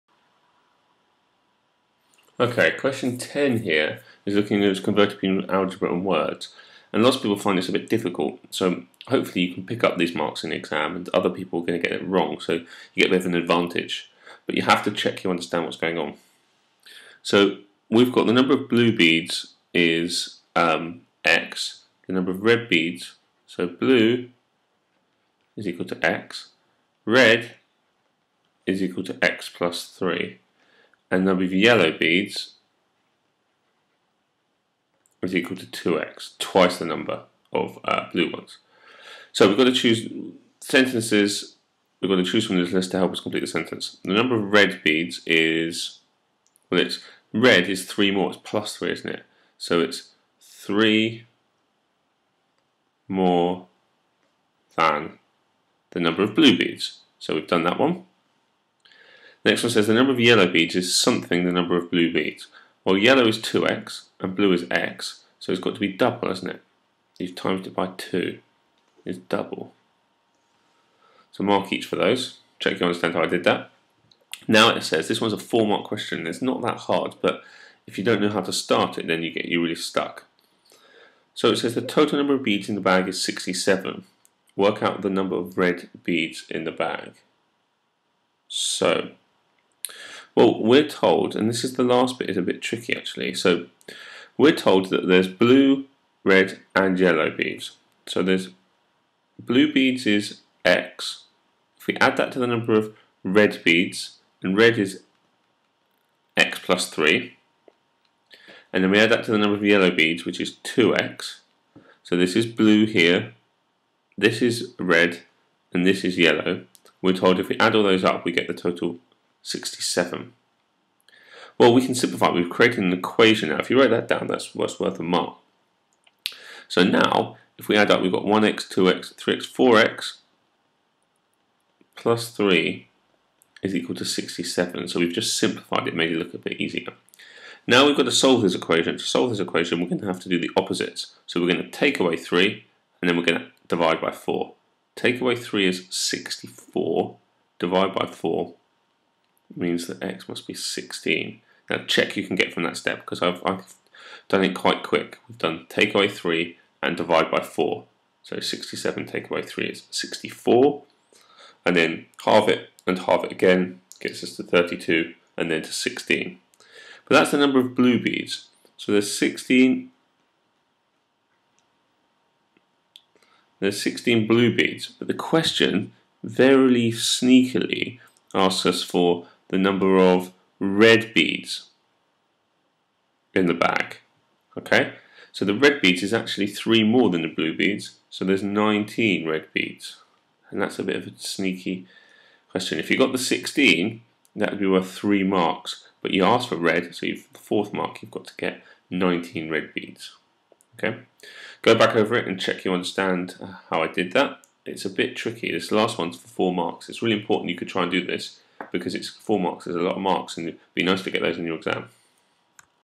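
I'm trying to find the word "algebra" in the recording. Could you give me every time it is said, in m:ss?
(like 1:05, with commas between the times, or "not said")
0:05.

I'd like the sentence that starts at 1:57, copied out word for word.
We're told if we add all those up, we get the total 67.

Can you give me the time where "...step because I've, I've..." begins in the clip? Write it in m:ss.
2:32.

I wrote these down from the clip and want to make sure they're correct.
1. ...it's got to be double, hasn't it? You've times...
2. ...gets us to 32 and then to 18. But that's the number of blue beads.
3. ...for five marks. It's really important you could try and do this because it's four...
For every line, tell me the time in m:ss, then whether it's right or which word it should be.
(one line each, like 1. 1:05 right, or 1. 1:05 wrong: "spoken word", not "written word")
1. 1:05 right
2. 2:43 wrong: "16", not "18"
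3. 3:26 wrong: "four", not "five".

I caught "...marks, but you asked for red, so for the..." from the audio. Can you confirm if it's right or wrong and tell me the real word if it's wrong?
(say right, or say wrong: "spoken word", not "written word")
right.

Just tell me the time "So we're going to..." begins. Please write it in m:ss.
2:21.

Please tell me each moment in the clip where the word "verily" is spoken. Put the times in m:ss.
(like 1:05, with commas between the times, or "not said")
2:56.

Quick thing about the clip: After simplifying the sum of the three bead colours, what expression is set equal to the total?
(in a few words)
4x plus 3.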